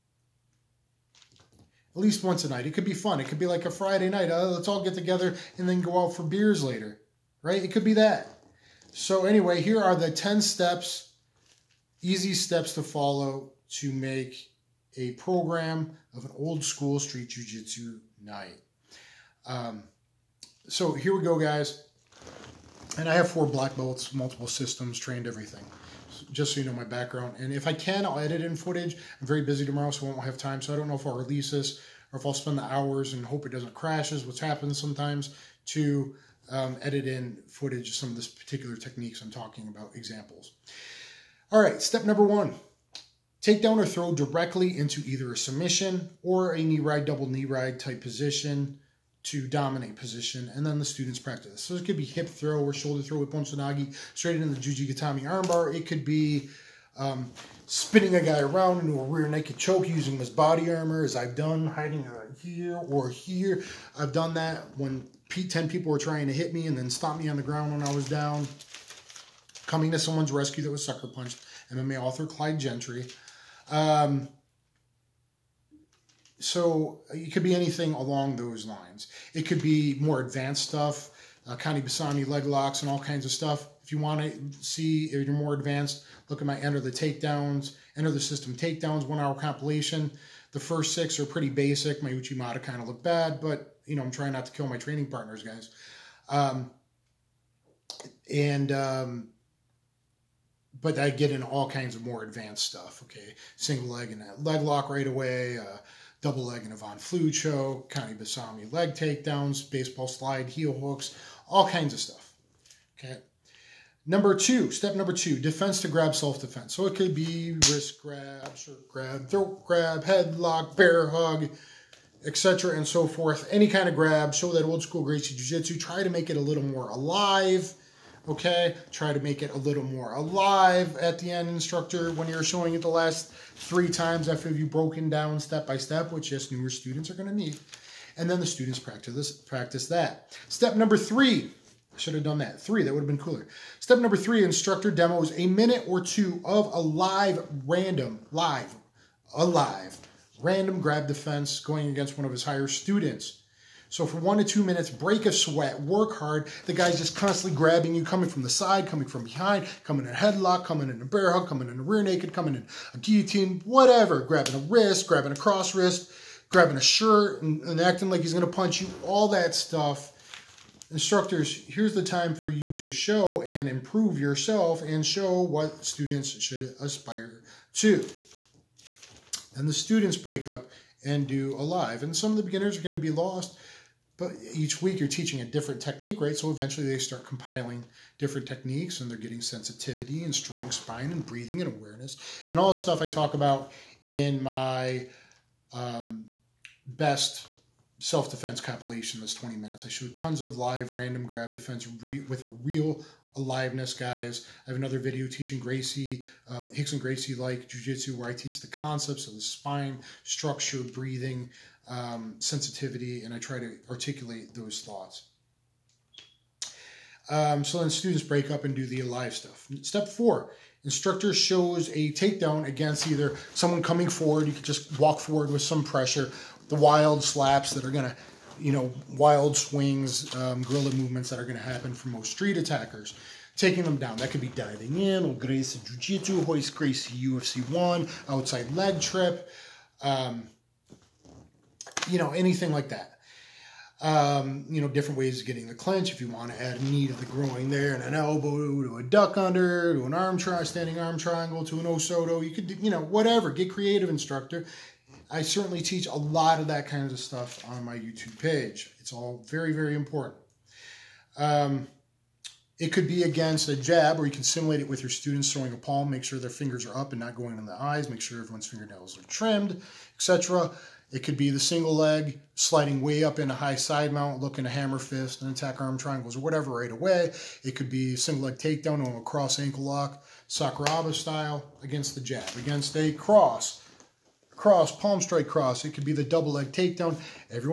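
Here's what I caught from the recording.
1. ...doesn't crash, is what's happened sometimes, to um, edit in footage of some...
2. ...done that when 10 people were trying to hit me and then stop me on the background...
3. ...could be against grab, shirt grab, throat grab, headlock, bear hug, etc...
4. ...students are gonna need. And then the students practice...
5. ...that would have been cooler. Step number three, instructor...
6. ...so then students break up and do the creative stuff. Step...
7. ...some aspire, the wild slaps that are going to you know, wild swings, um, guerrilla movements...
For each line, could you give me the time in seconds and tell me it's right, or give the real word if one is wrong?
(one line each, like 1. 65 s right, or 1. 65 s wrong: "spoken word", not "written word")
1. 33 s right
2. 64 s wrong: "ground", not "background"
3. 116 s wrong: "wrist", not "against"
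4. 136 s right
5. 142 s right
6. 217 s wrong: "alive", not "creative"
7. 225 s wrong: "pressure", not "aspire".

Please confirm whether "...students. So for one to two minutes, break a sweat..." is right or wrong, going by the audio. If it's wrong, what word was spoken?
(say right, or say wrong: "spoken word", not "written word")
right.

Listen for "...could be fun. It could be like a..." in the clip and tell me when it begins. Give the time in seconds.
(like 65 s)
2 s.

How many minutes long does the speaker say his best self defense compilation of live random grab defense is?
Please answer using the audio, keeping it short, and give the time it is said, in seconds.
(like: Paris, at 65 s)
20, at 199 s.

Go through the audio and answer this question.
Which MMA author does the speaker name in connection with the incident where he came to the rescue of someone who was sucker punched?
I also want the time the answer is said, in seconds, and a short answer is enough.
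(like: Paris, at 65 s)
Clyde Gentry, at 72 s.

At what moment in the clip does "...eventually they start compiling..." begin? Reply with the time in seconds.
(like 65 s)
186 s.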